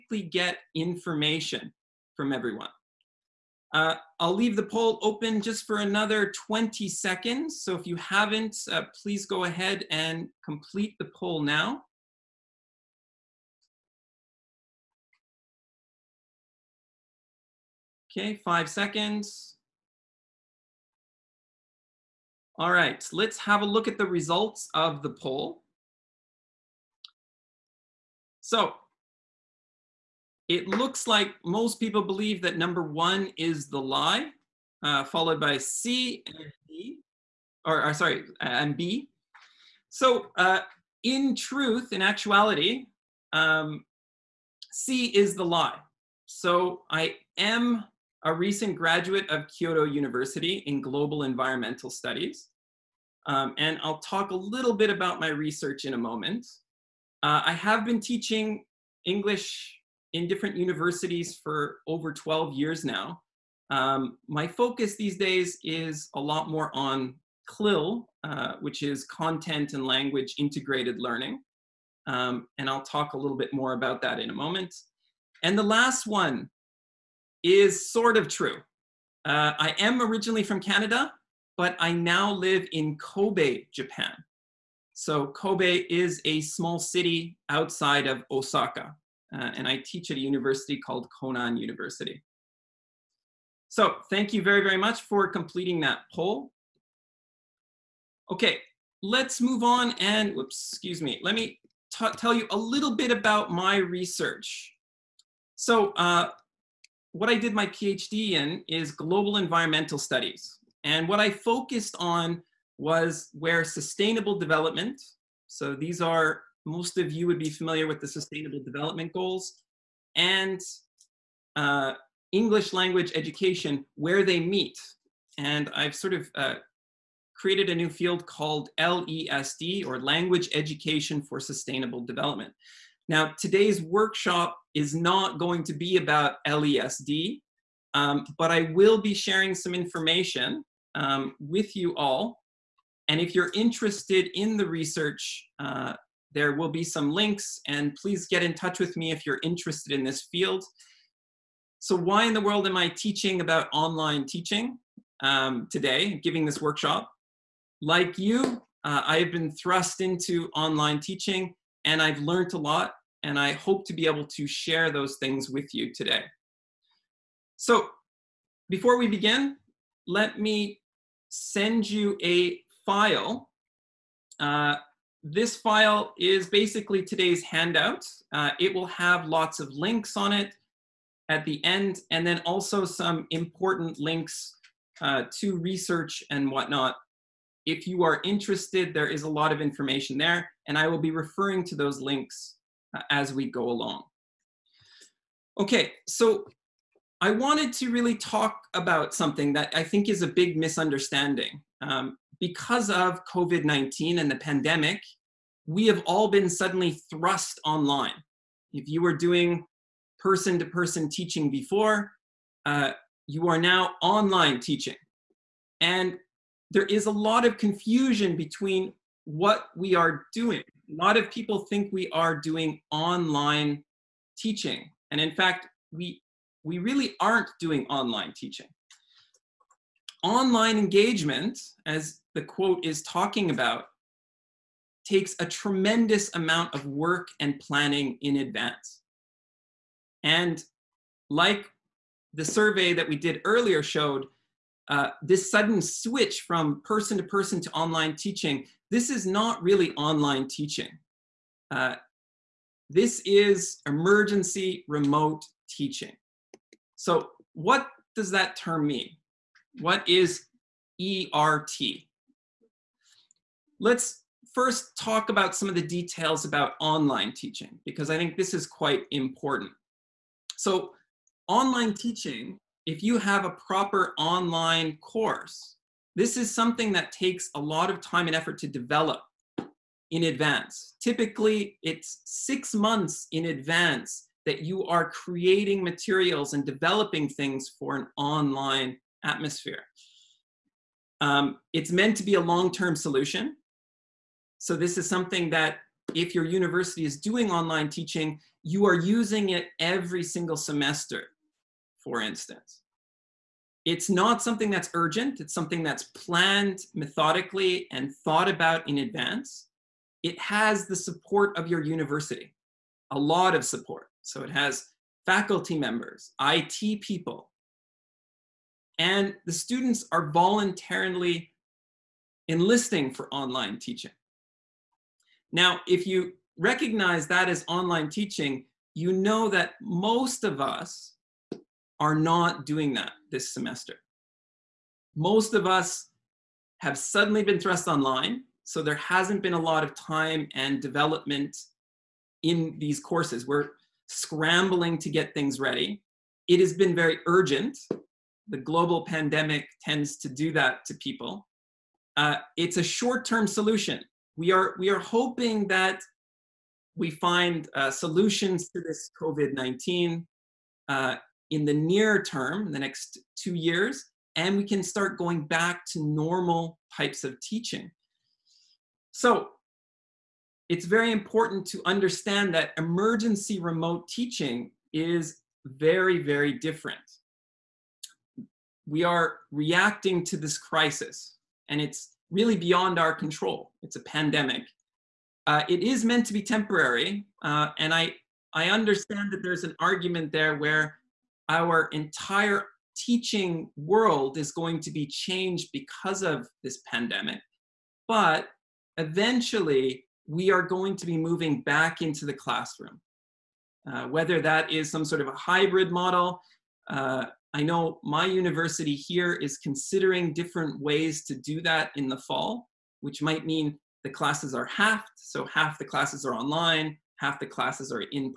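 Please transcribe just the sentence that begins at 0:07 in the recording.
So if you haven't, uh, please go ahead and complete the poll now.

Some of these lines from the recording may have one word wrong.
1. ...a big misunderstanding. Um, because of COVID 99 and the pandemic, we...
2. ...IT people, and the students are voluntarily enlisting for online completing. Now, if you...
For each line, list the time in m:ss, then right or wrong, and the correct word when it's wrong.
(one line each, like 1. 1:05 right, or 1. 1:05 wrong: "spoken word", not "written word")
1. 3:20 wrong: "19", not "99"
2. 5:16 wrong: "teaching", not "completing".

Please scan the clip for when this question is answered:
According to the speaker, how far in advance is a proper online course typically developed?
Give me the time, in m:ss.
4:42.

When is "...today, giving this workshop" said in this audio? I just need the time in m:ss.
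2:35.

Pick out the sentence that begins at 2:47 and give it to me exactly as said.
So before we begin, let me send you a file.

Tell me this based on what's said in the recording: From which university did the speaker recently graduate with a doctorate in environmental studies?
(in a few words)
Kyoto University.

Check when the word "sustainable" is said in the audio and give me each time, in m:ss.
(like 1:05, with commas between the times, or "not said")
1:53, 1:58, 2:11.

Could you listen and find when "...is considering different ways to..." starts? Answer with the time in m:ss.
6:49.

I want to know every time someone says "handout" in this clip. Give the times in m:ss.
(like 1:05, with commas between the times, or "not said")
2:57.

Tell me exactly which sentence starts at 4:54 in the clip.
So this is something that if your university is doing online teaching, you are using it every single semester, for instance.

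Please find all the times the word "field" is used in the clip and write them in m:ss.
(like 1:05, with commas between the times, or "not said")
2:07, 2:30.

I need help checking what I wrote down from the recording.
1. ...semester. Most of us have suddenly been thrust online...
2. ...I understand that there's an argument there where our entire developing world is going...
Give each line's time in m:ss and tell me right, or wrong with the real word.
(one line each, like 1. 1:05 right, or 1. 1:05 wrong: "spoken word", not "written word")
1. 5:33 right
2. 6:28 wrong: "teaching", not "developing".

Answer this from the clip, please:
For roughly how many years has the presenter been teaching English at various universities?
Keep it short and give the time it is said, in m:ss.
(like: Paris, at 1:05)
12, at 1:02.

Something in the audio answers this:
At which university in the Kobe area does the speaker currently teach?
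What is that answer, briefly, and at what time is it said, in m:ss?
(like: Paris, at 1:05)
Konan University, at 1:31.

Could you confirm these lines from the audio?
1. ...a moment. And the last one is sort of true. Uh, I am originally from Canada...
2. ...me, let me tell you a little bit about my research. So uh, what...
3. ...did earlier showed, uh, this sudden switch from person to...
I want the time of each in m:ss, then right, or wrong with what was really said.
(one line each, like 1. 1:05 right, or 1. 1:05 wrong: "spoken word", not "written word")
1. 1:14 right
2. 1:41 right
3. 4:03 right.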